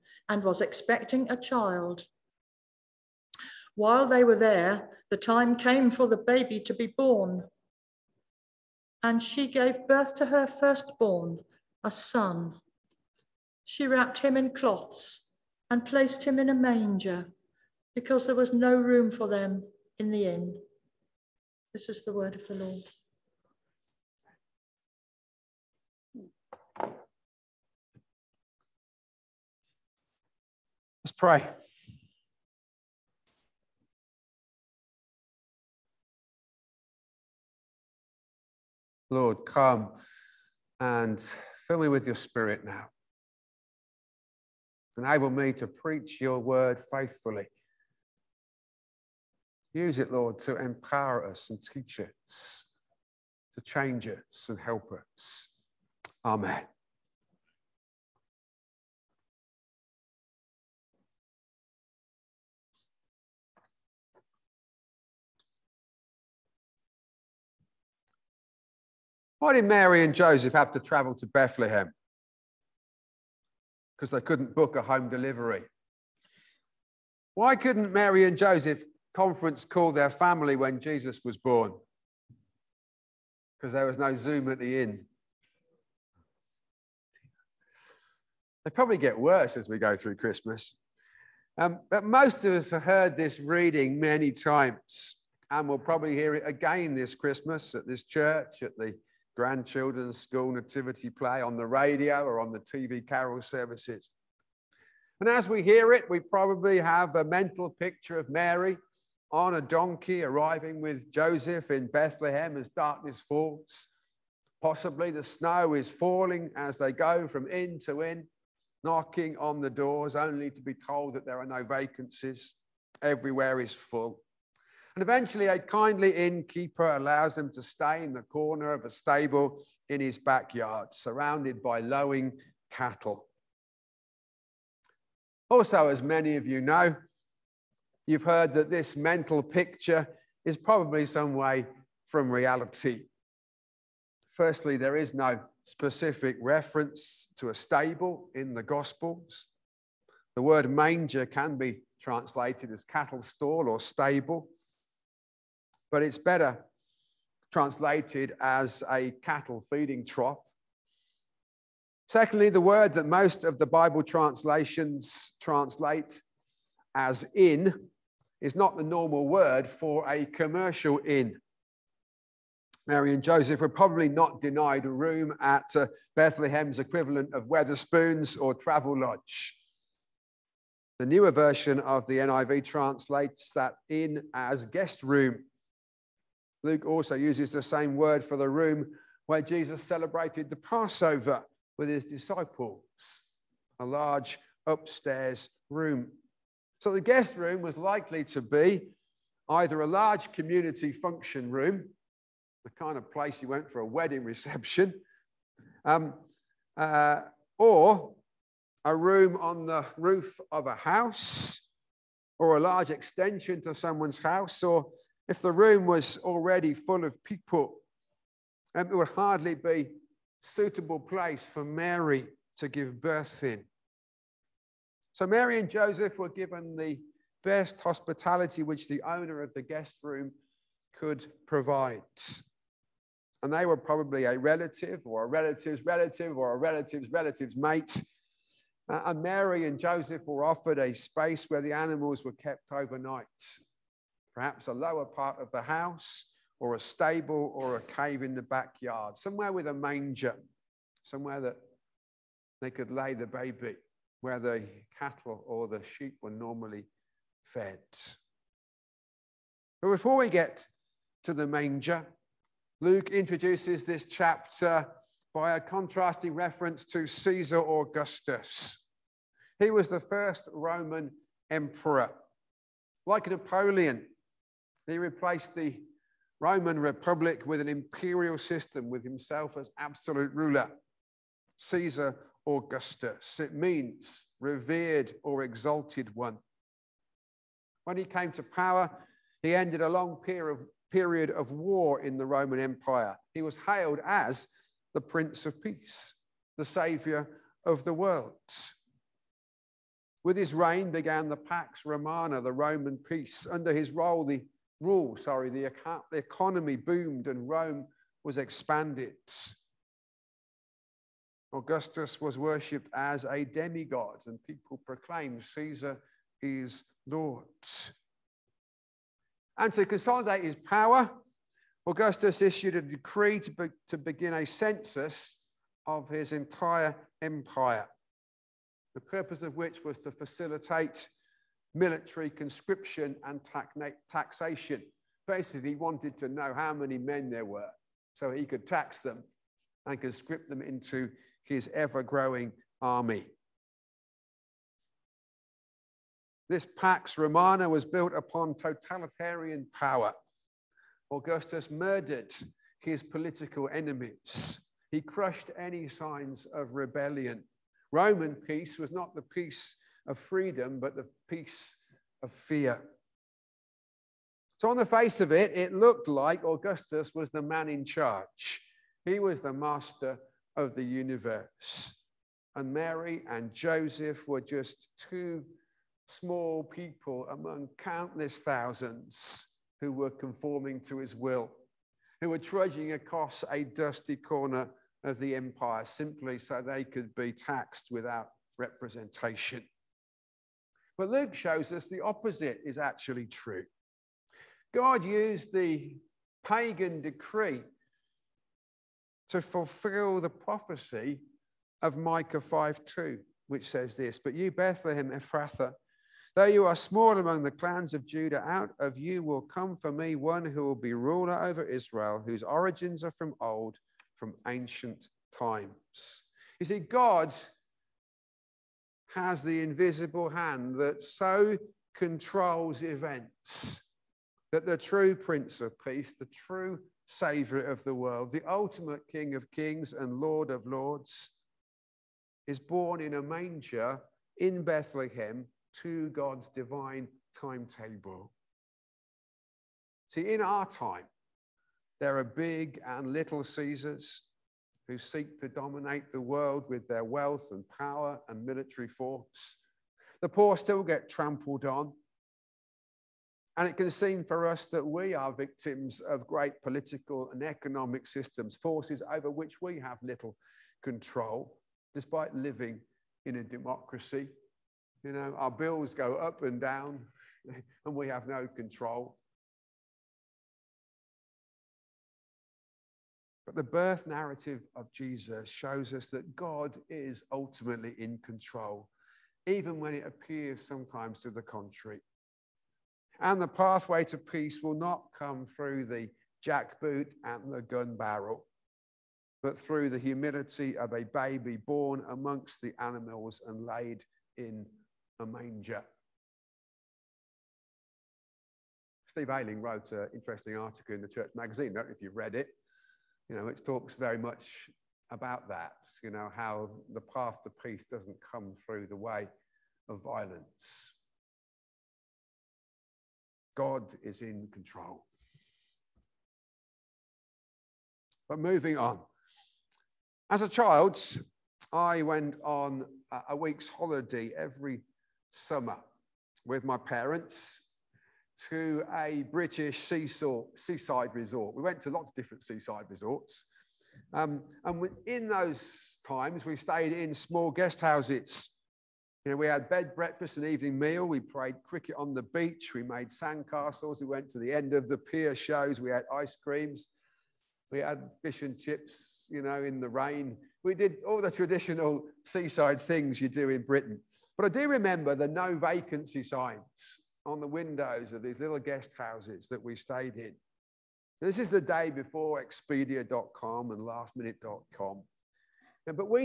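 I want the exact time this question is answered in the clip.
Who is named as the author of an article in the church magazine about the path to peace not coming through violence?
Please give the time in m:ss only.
8:19.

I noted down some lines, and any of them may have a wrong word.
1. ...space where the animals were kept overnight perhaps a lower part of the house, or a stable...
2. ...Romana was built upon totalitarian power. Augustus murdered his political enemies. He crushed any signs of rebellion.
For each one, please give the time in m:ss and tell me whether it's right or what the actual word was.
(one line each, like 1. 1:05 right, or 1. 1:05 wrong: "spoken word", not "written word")
1. 4:00 right
2. 5:47 right.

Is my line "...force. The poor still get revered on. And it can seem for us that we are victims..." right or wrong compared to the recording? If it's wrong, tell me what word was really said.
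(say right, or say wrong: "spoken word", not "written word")
wrong: "trampled", not "revered".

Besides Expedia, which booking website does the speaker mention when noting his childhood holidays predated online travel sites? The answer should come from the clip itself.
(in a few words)
lastminute.com.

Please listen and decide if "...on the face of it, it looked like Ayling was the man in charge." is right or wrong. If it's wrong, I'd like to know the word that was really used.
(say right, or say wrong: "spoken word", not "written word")
wrong: "Augustus", not "Ayling".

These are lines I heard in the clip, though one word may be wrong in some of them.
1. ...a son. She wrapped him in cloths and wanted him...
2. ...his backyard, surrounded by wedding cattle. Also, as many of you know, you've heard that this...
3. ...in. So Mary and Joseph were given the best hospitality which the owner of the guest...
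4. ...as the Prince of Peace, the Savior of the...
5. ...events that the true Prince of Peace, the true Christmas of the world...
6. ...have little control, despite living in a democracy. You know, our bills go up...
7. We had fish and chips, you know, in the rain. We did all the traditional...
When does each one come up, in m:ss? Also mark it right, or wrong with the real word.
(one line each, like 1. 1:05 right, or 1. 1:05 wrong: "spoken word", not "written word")
1. 0:11 wrong: "placed", not "wanted"
2. 2:10 wrong: "lowing", not "wedding"
3. 3:43 right
4. 4:54 right
5. 7:02 wrong: "Savior", not "Christmas"
6. 7:39 right
7. 9:07 right.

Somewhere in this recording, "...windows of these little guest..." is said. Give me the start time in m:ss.
9:17.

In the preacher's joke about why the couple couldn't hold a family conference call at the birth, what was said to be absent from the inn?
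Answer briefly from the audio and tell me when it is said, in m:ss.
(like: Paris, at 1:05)
Zoom, at 1:24.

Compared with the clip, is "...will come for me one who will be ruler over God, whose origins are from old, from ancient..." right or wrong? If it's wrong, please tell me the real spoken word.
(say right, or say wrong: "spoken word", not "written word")
wrong: "Israel", not "God".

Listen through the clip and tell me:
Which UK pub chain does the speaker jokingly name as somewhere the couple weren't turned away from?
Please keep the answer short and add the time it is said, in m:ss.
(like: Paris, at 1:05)
Wetherspoons, at 2:57.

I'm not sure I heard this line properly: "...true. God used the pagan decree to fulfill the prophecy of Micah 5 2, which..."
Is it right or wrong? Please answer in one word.
right.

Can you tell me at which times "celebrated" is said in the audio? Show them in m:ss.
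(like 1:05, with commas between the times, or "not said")
3:09.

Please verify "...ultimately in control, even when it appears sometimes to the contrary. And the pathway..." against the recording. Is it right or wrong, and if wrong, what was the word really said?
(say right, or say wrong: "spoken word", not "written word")
right.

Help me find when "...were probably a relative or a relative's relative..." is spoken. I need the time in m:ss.
3:53.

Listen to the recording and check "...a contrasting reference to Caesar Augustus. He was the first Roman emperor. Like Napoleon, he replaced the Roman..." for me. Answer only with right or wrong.
right.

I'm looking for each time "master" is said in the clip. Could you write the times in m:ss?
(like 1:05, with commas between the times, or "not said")
6:09.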